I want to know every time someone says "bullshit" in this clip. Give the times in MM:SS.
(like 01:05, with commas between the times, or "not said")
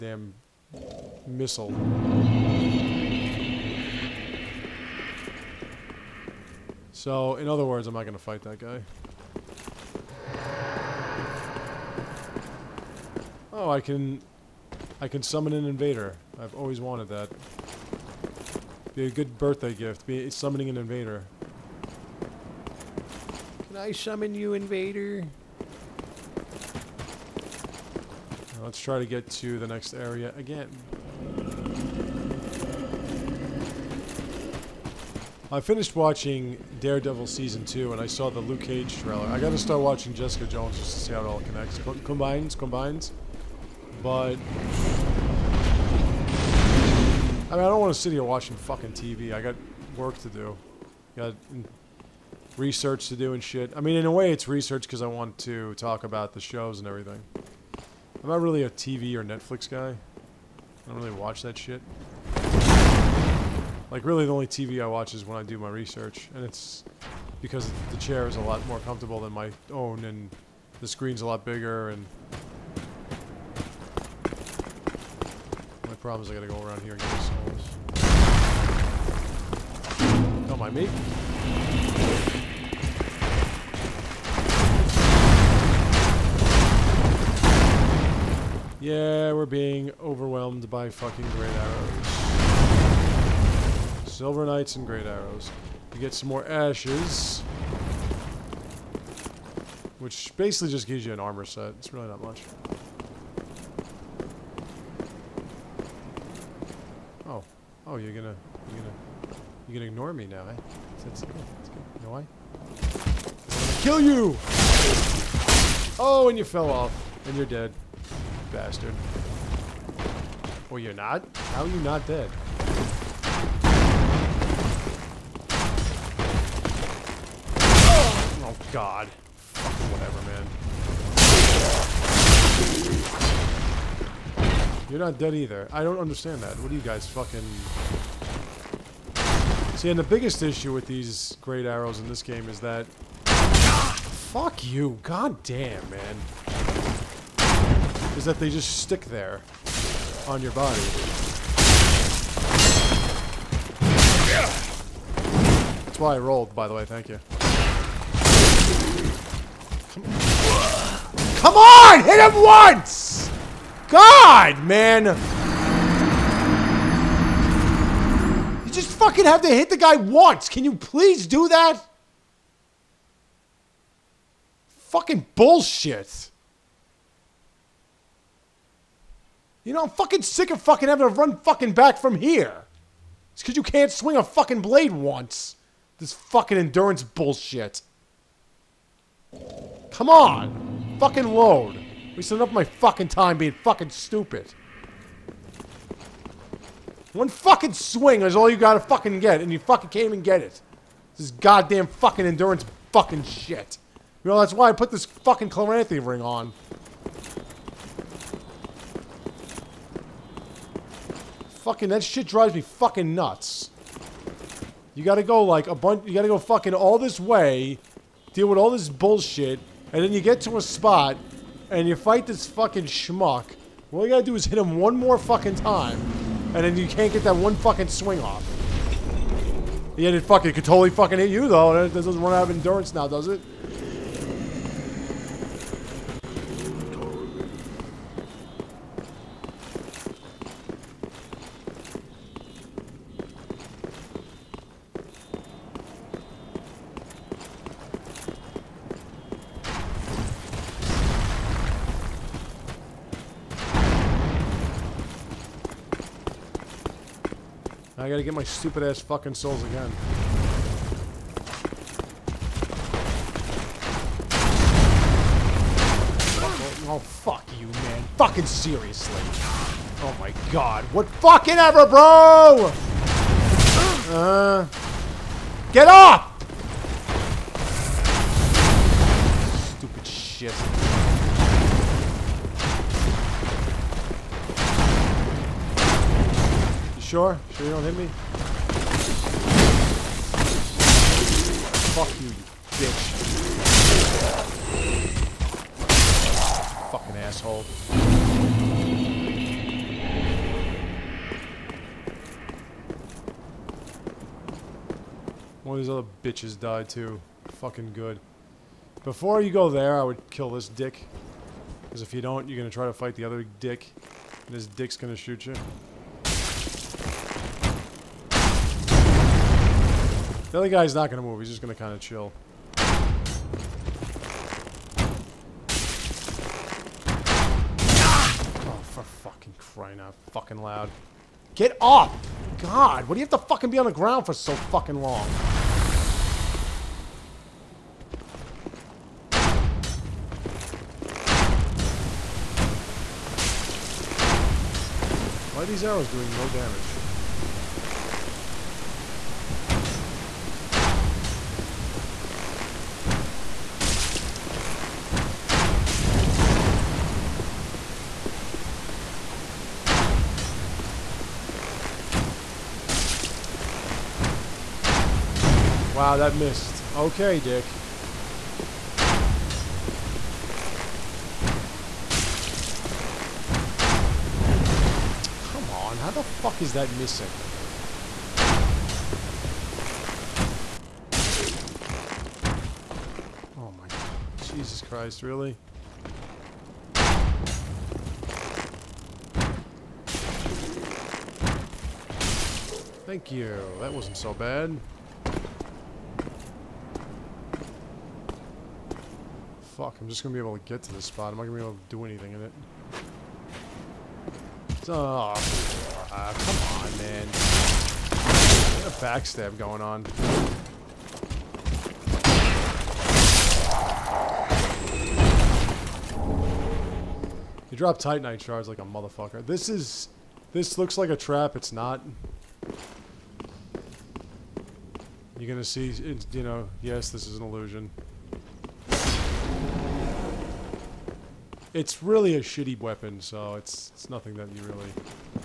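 02:55, 03:07, 03:38.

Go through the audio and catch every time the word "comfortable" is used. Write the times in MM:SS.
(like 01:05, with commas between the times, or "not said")
01:08.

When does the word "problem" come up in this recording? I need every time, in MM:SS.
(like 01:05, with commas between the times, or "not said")
01:15.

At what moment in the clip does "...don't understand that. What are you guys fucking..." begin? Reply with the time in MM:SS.
02:15.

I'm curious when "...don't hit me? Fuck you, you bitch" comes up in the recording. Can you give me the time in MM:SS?
04:47.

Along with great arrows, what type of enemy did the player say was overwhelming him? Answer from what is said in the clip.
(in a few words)
Silver Knights.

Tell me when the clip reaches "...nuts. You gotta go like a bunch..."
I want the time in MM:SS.
03:33.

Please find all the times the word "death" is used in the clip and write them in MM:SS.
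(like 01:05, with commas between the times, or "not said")
not said.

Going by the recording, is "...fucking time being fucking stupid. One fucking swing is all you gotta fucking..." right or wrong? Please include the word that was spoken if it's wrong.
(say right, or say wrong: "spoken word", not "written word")
right.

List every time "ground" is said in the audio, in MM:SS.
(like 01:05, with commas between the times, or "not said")
05:33.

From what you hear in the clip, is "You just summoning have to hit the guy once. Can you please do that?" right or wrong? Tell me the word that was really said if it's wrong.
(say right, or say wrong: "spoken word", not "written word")
wrong: "fucking", not "summoning".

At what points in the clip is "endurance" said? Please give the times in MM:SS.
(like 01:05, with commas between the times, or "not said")
03:06, 03:22, 03:52.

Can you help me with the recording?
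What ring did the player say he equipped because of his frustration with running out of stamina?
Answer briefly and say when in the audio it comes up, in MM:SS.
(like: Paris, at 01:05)
Chloranthy ring, at 03:25.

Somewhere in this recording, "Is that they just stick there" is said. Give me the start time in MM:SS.
02:28.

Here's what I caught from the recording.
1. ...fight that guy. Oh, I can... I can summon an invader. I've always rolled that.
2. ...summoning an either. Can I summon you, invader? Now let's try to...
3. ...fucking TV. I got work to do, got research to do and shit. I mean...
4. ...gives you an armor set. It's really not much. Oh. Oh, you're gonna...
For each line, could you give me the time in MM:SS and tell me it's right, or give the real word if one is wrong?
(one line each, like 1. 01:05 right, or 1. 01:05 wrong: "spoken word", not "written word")
1. 00:08 wrong: "wanted", not "rolled"
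2. 00:20 wrong: "invader", not "either"
3. 00:48 right
4. 01:40 right.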